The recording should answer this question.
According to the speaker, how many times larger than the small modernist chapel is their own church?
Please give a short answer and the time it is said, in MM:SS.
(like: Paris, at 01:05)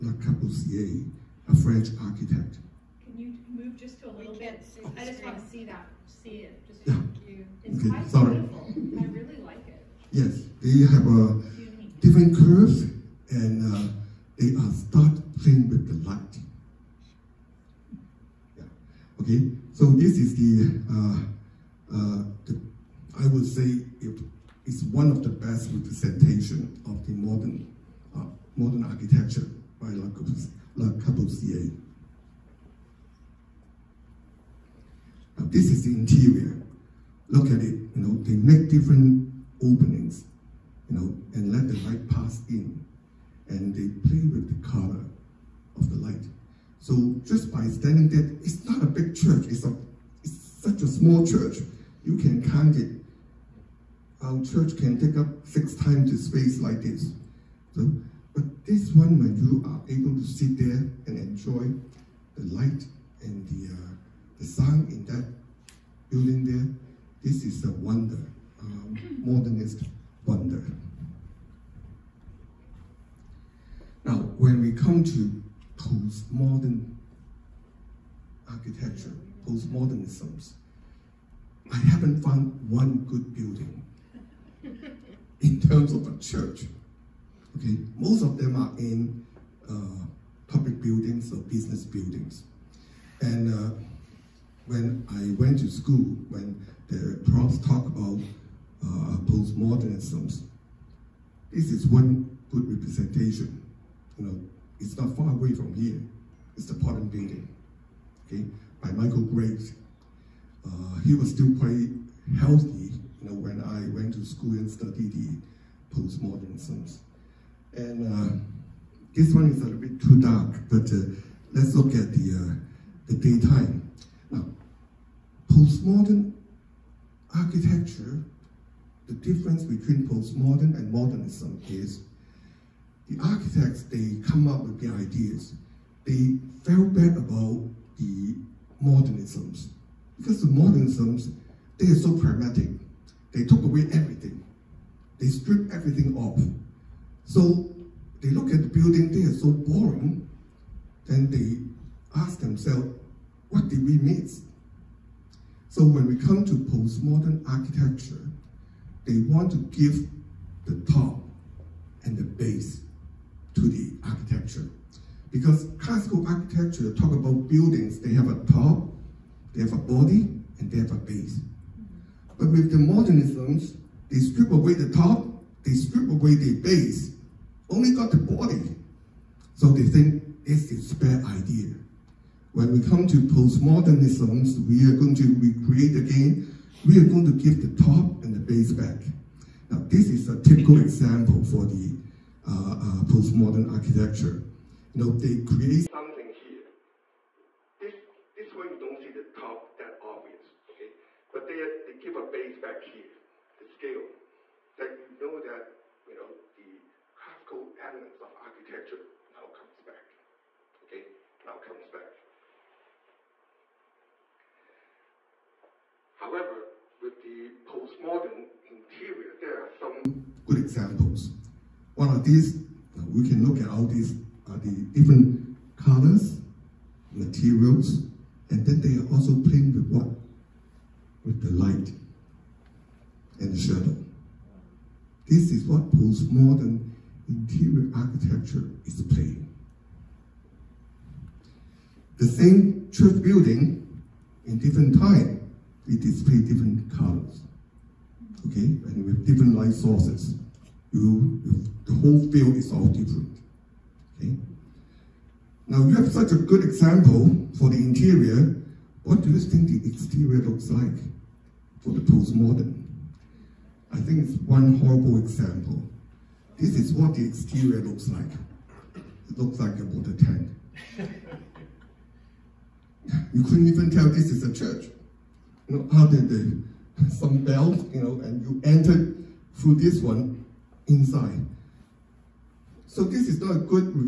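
6, at 00:55.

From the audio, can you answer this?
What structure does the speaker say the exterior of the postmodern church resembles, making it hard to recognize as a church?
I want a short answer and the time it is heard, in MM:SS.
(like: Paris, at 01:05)
A water tank, at 04:29.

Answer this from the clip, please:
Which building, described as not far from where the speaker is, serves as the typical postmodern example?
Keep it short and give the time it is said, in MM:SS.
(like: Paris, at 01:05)
The Portland Building, at 01:46.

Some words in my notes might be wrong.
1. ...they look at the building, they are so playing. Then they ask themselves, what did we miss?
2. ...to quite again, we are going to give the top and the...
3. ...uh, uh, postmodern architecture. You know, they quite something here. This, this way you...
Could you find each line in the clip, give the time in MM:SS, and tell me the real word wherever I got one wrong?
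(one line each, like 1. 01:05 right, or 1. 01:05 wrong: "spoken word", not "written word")
1. 02:28 wrong: "boring", not "playing"
2. 03:05 wrong: "recreate", not "quite"
3. 03:12 wrong: "create", not "quite".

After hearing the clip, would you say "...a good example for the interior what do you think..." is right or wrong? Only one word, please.
right.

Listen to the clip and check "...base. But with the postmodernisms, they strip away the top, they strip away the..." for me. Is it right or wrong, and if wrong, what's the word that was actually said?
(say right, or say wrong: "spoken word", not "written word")
wrong: "modernisms", not "postmodernisms".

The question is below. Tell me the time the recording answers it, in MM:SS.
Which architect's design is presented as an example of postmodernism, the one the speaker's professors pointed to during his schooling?
01:48.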